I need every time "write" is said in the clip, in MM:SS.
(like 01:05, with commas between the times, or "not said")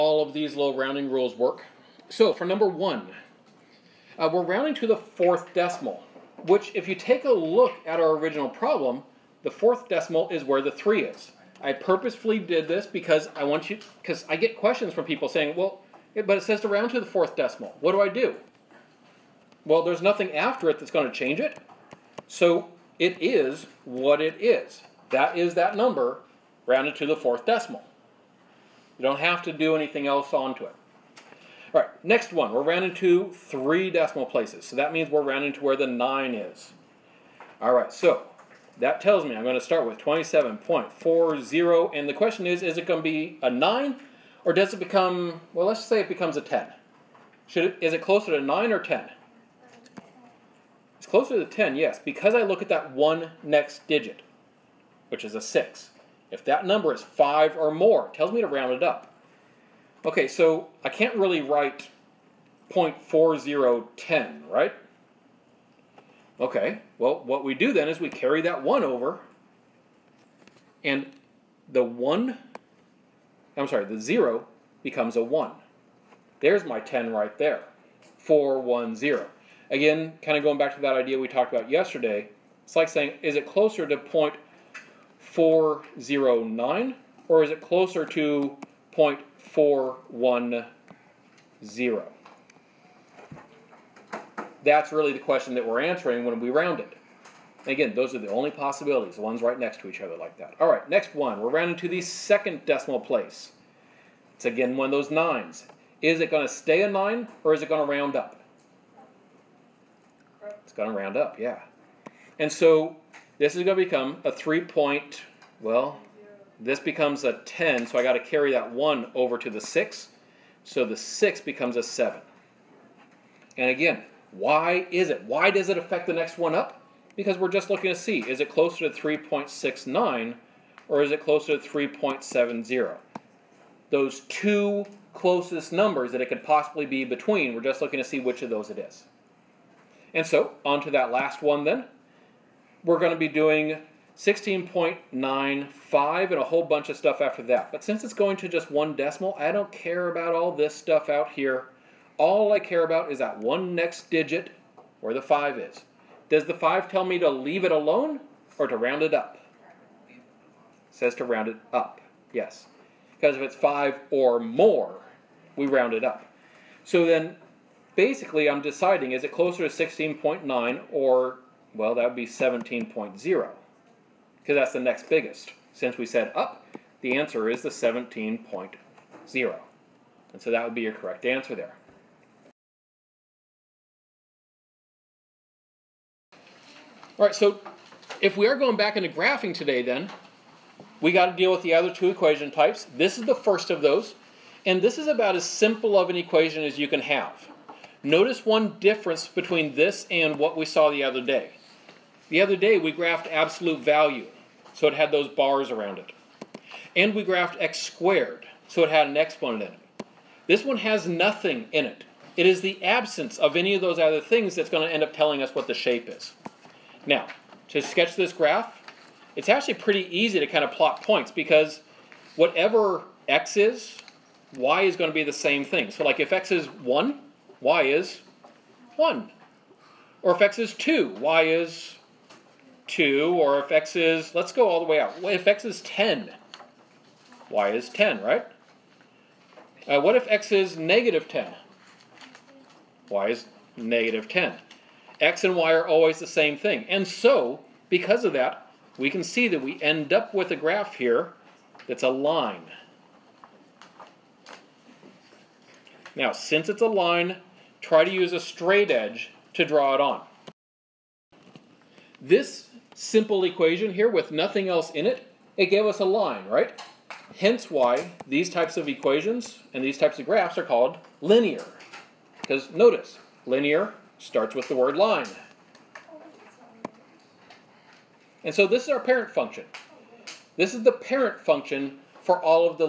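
01:01.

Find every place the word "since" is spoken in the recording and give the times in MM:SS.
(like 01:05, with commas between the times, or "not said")
02:27, 02:55, 04:16.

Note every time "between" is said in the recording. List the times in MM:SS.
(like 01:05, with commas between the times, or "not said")
02:17, 03:19.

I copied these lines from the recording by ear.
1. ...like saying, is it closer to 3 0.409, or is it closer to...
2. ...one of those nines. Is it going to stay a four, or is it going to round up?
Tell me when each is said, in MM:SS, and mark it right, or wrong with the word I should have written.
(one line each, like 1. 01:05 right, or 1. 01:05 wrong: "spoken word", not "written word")
1. 01:22 wrong: "0", not "3"
2. 01:44 wrong: "nine", not "four".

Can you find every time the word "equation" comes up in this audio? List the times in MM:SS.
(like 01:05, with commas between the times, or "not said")
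03:12, 03:16, 04:23, 04:28.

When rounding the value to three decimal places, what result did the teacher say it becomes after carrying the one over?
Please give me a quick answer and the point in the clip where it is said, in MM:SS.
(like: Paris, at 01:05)
0.410, at 01:18.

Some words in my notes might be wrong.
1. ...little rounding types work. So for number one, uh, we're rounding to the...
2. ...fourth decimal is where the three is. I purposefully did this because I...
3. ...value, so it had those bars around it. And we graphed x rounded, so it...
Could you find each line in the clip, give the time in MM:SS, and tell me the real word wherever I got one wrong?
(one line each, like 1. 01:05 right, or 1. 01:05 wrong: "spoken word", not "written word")
1. 00:00 wrong: "rules", not "types"
2. 00:09 right
3. 03:23 wrong: "squared", not "rounded".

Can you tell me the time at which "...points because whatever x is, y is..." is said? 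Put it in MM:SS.
03:41.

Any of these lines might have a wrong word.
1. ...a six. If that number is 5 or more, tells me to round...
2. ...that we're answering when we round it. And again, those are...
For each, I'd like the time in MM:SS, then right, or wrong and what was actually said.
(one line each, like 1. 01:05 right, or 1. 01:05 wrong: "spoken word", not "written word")
1. 00:55 right
2. 01:35 right.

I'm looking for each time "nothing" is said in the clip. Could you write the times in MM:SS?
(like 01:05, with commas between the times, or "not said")
00:20, 03:31, 04:24.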